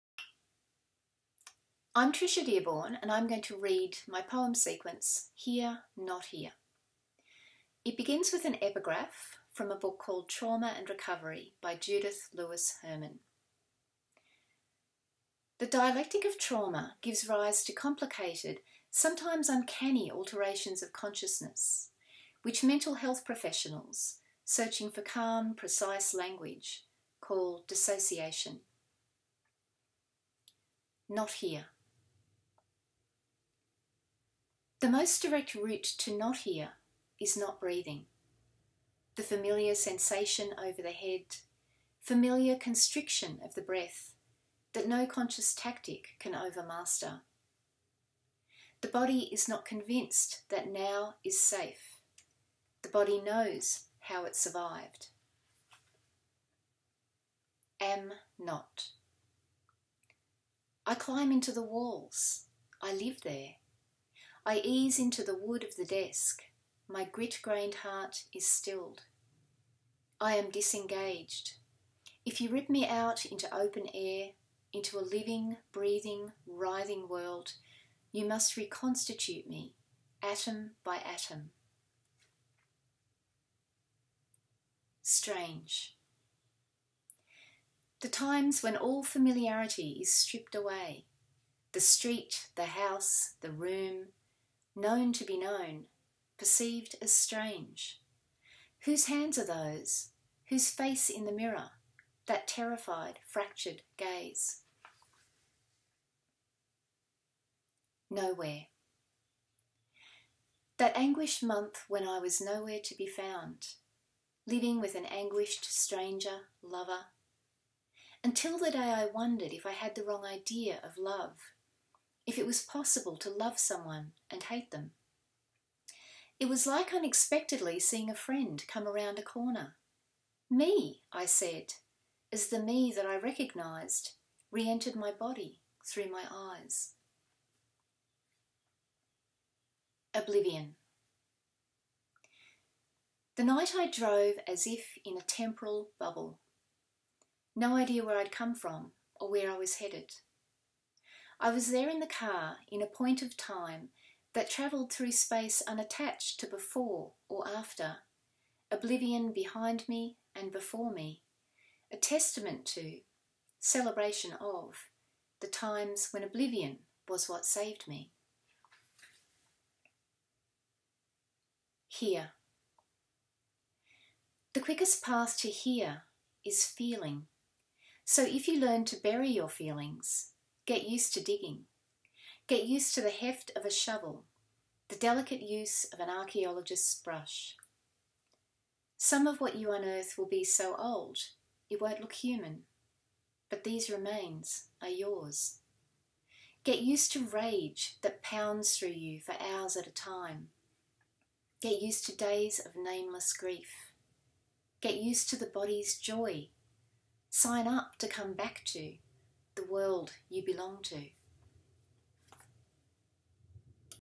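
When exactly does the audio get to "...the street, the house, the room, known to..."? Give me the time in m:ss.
1:31.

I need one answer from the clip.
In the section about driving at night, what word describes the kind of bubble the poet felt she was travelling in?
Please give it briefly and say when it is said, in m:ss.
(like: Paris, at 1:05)
temporal, at 2:25.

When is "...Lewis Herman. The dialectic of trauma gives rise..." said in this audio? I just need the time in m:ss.
0:12.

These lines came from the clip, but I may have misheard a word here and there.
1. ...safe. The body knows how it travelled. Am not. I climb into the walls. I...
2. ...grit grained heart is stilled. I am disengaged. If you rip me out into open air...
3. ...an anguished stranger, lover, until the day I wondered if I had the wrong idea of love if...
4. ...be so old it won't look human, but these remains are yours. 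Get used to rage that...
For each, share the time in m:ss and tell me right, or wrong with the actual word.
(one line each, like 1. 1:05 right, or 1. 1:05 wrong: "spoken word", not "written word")
1. 0:51 wrong: "survived", not "travelled"
2. 1:07 right
3. 1:54 right
4. 3:10 right.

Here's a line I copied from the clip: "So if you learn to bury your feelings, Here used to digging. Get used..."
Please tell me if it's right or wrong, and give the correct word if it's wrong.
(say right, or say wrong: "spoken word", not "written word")
wrong: "Get", not "Here".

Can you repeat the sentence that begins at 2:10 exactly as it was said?
Me, I said, as the me that I recognised re entered my body through my eyes.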